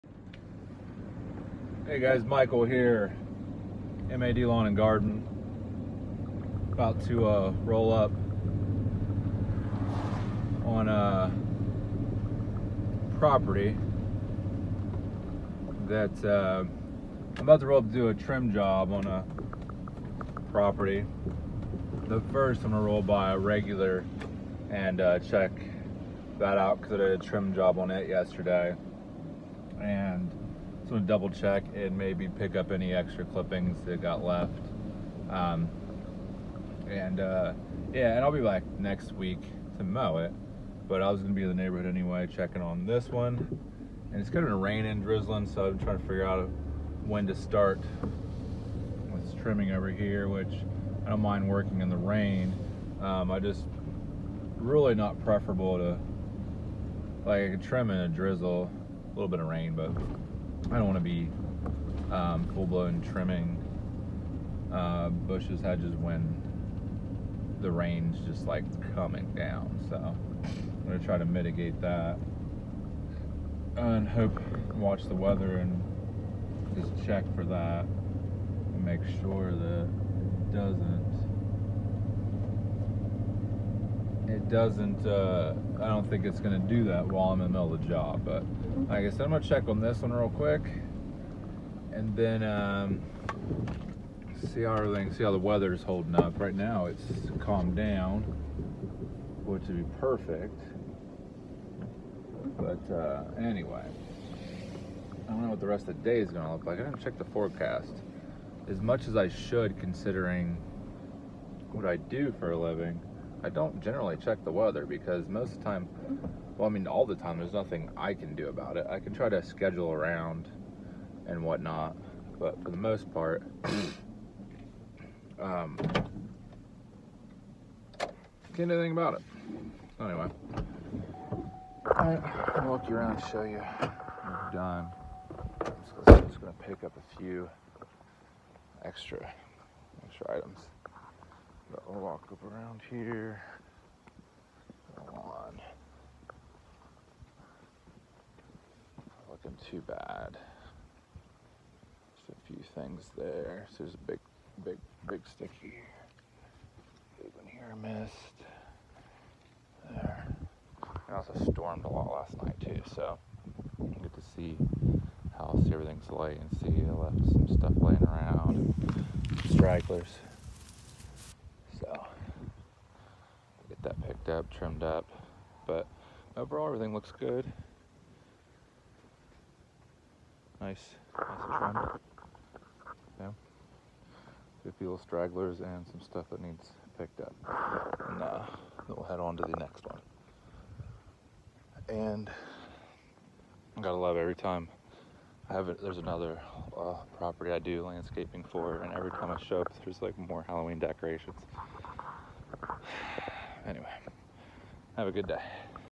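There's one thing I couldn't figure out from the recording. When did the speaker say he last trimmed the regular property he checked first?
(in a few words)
yesterday.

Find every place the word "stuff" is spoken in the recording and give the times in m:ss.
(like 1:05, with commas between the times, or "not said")
2:47, 3:06.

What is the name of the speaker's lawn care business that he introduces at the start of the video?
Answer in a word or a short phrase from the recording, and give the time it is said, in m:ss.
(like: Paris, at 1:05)
MAD Lawn and Garden, at 0:04.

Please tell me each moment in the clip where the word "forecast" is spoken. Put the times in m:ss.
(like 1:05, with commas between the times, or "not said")
1:47.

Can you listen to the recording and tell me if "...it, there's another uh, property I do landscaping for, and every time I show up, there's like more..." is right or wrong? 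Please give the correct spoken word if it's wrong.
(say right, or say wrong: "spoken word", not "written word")
right.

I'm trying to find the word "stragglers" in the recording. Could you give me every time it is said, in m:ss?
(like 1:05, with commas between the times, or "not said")
2:49, 3:05.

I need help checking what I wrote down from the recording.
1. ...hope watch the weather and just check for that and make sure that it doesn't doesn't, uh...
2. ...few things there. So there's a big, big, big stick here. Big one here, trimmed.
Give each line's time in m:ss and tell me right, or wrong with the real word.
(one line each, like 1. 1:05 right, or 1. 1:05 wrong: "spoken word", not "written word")
1. 1:14 right
2. 2:32 wrong: "missed", not "trimmed".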